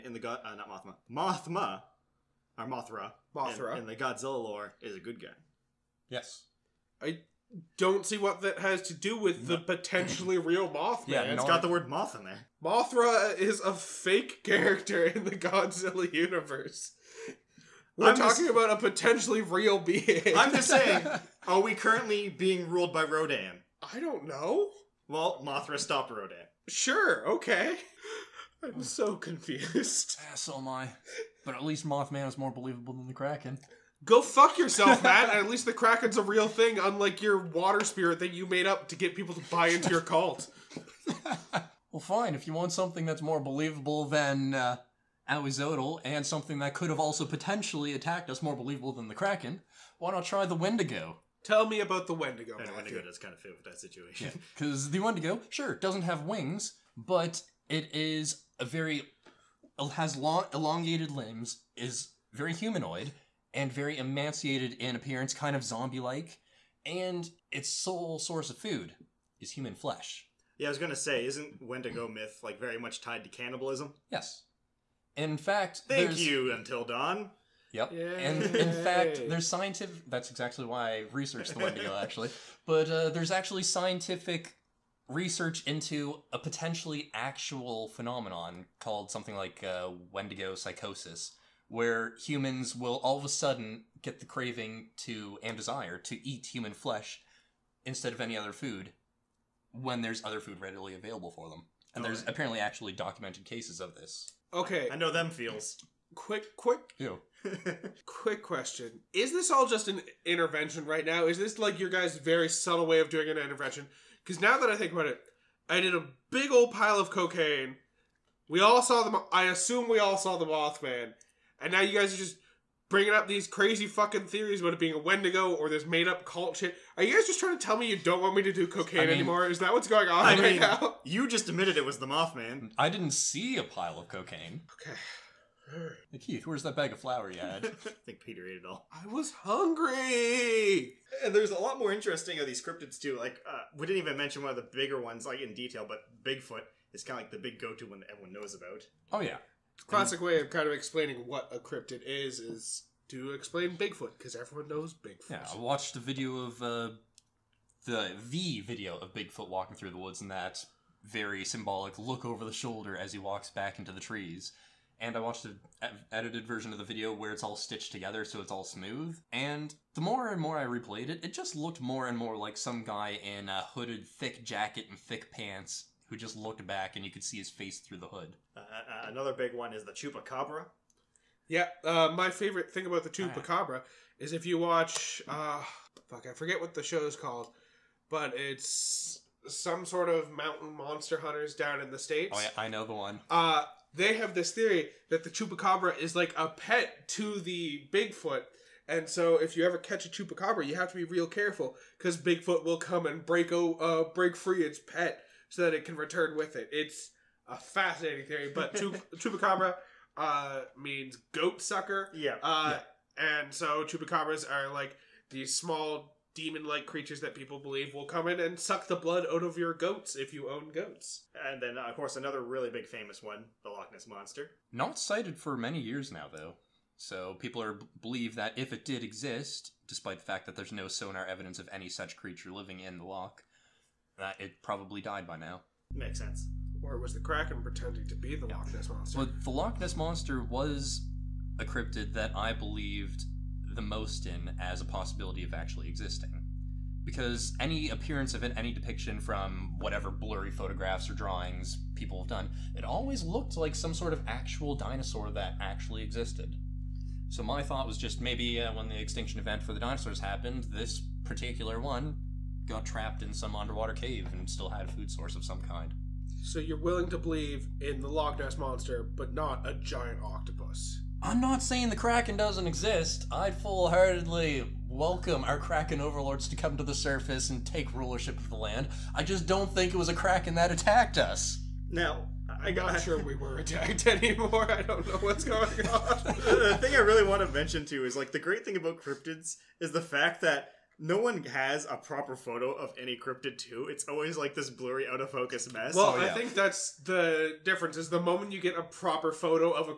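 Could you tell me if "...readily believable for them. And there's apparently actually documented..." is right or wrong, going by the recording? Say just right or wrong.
wrong.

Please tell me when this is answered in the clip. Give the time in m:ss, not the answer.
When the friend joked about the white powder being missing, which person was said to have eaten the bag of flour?
2:18.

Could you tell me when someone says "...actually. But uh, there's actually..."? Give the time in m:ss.
1:22.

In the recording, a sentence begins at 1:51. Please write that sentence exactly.
Is this like your guys' very subtle way of doing an intervention?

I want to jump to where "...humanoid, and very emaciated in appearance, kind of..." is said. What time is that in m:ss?
1:02.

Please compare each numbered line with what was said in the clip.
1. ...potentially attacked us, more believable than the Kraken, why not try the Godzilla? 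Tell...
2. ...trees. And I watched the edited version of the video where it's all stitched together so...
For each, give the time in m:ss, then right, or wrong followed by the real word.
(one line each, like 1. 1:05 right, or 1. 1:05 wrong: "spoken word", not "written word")
1. 0:47 wrong: "Wendigo", not "Godzilla"
2. 2:43 right.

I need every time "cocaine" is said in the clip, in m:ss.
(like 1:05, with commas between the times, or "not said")
1:57, 2:08, 2:14.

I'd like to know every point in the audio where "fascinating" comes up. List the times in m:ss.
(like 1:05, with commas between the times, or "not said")
3:27.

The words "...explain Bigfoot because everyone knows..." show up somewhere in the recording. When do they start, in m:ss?
2:33.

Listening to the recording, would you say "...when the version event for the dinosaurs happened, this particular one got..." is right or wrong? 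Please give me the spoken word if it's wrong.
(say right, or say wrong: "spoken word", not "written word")
wrong: "extinction", not "version".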